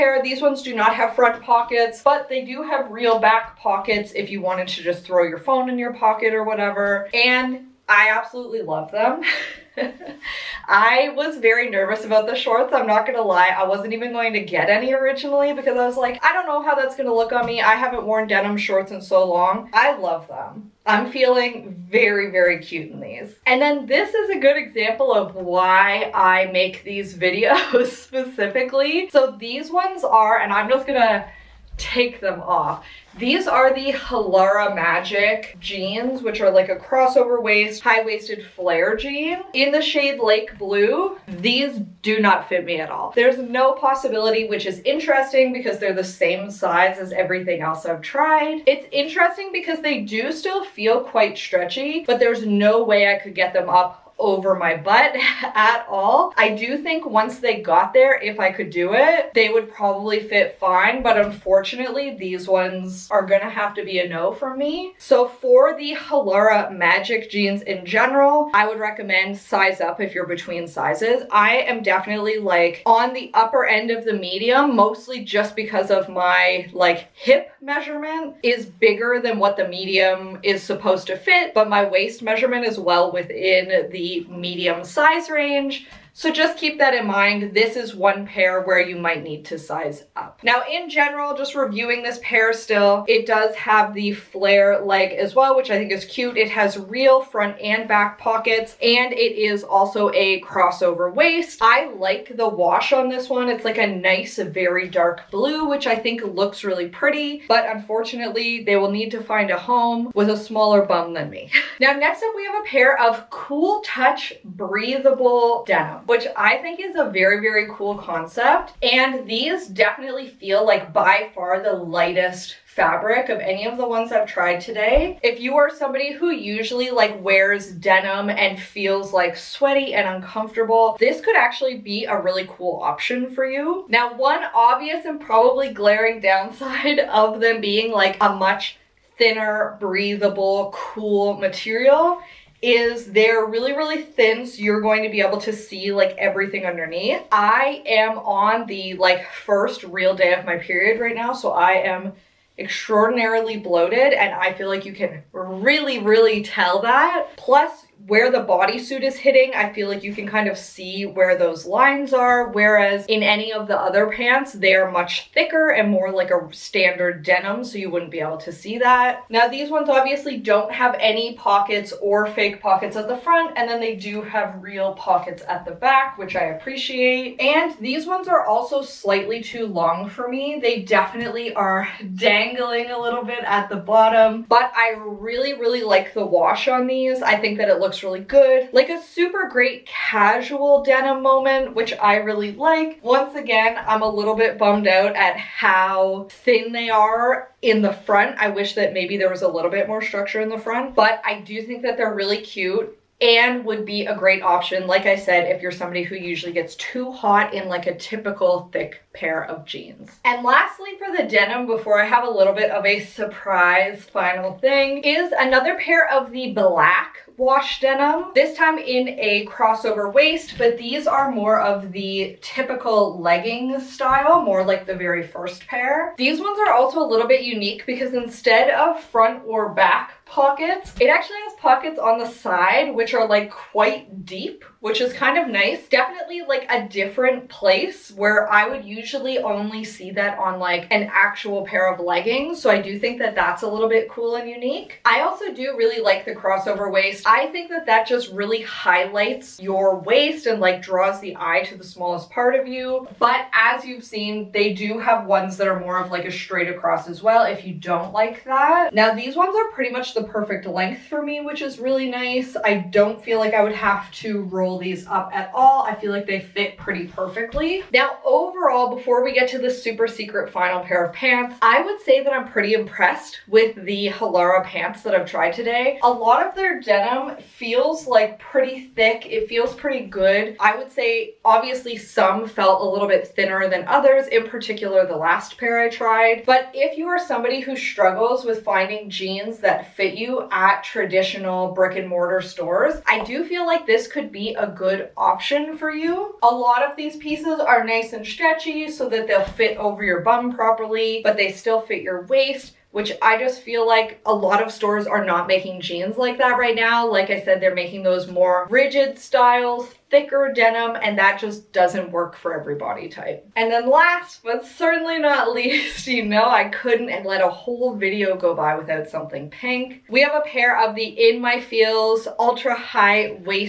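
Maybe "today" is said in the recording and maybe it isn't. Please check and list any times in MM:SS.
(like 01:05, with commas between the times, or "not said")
02:04, 04:35.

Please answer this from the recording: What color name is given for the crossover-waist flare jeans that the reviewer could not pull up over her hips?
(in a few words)
Lake Blue.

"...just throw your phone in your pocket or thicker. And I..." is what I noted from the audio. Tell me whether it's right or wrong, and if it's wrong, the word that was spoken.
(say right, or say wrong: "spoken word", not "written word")
wrong: "whatever", not "thicker".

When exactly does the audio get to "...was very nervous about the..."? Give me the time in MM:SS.
00:11.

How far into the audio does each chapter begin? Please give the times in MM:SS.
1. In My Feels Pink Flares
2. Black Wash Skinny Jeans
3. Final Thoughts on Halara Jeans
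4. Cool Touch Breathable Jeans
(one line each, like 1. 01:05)
1. 05:12
2. 03:29
3. 04:27
4. 01:50.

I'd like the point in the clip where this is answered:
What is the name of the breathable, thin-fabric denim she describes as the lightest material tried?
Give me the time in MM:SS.
01:53.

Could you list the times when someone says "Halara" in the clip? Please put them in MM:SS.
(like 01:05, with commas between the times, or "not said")
00:33, 01:05, 04:34.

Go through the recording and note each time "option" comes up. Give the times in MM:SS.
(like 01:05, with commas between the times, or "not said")
02:12, 03:24, 04:55.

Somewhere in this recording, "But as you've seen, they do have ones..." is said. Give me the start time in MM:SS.
04:13.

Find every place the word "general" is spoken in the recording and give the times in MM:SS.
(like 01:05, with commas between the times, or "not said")
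01:07, 01:30.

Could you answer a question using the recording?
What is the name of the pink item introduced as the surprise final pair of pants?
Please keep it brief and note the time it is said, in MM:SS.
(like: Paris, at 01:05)
In My Feels, at 05:21.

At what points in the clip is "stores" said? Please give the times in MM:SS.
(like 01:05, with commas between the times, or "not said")
04:52, 05:04.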